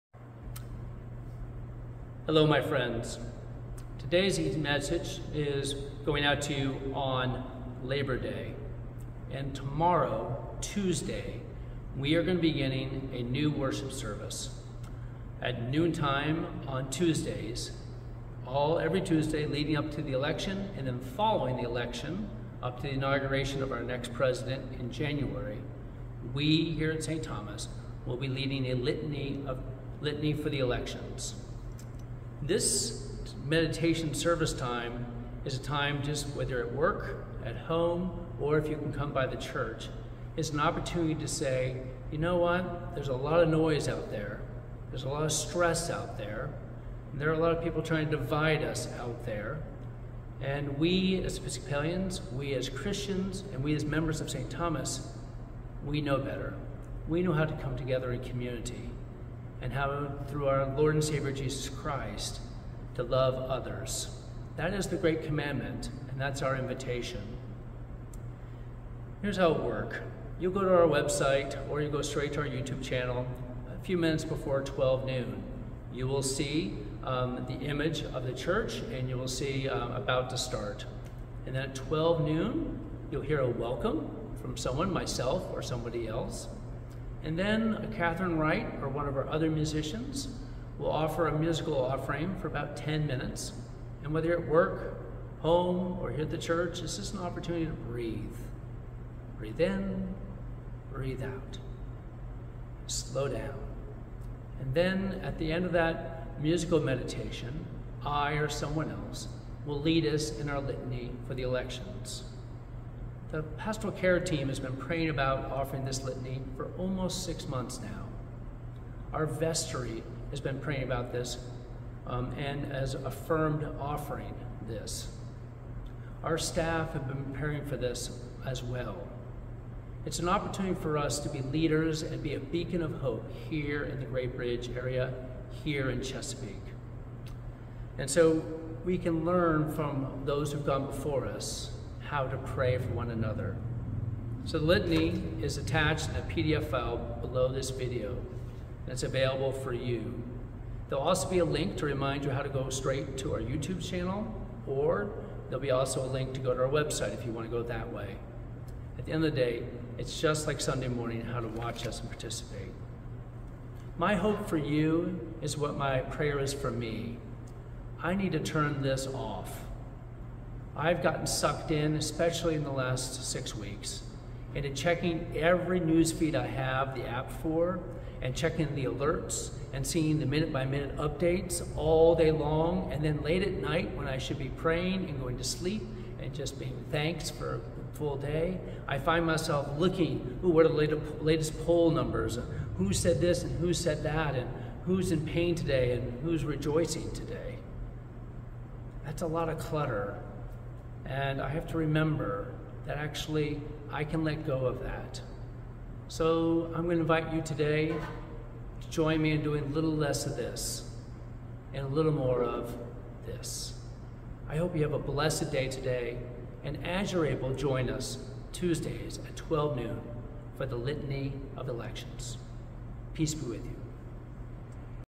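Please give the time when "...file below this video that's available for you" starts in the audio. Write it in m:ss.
2:26.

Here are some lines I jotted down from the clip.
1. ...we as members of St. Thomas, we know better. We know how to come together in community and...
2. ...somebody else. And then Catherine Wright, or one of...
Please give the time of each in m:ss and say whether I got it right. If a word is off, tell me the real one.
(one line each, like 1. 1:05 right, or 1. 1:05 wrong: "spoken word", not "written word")
1. 0:53 right
2. 1:25 right.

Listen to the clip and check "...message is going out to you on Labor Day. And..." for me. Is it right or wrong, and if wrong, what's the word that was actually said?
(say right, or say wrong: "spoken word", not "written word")
right.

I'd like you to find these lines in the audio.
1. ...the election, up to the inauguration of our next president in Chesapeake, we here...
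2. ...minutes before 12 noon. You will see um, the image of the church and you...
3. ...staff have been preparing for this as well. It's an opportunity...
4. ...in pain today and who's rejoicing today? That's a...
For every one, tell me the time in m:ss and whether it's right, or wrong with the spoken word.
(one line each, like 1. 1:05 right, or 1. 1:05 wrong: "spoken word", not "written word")
1. 0:21 wrong: "January", not "Chesapeake"
2. 1:13 right
3. 2:06 right
4. 3:15 right.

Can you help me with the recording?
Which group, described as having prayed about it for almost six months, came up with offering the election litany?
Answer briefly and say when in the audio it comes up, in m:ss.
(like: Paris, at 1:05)
pastoral care team, at 1:53.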